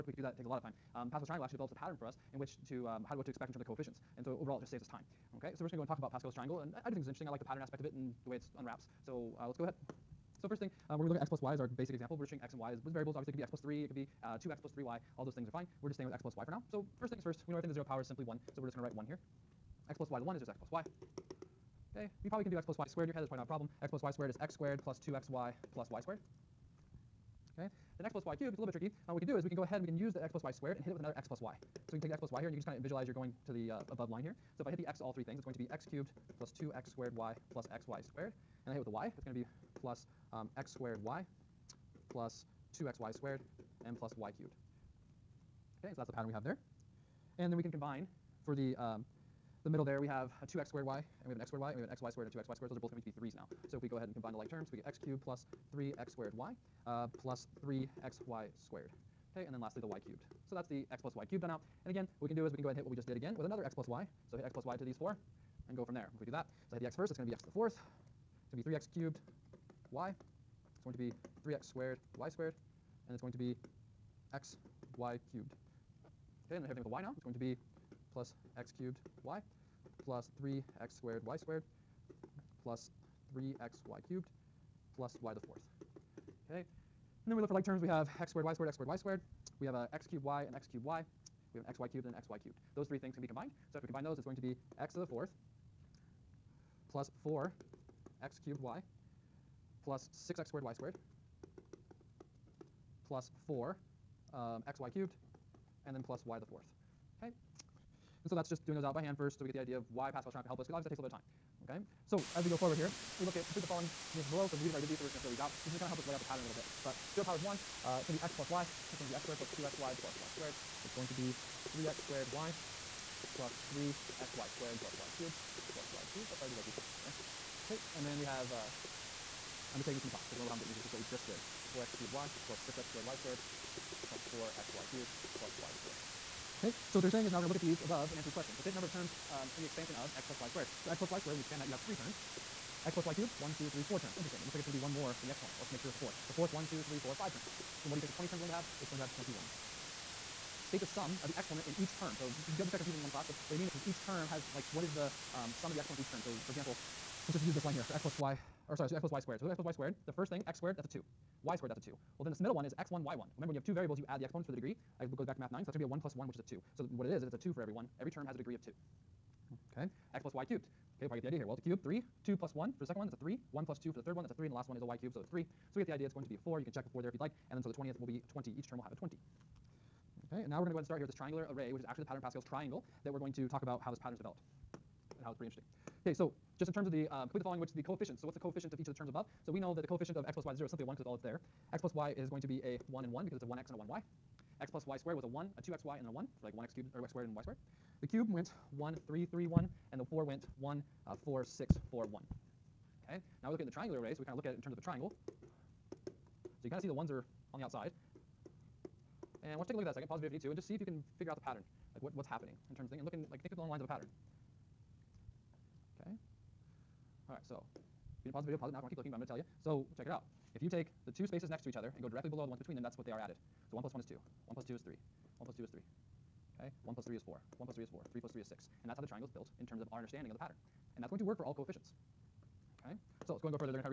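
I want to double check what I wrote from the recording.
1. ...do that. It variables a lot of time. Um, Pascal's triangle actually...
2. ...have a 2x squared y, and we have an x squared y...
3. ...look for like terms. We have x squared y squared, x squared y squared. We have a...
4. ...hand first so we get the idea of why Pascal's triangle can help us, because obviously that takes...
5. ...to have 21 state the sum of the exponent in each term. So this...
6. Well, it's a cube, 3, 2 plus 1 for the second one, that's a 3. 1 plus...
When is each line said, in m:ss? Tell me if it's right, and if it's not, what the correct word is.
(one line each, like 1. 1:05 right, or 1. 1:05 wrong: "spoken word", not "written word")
1. 0:00 wrong: "takes", not "variables"
2. 0:50 right
3. 1:27 right
4. 1:49 right
5. 2:28 right
6. 2:51 right.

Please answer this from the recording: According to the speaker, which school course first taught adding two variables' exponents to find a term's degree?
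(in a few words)
Math 9.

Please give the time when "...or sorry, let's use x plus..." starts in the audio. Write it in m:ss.
2:38.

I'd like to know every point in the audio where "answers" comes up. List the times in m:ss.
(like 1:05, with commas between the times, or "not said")
1:54, 2:18.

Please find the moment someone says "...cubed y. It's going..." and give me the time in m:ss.
1:08.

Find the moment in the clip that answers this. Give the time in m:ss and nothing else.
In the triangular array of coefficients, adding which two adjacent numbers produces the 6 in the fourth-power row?
3:48.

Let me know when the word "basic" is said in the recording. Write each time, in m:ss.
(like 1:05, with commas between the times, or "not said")
0:11.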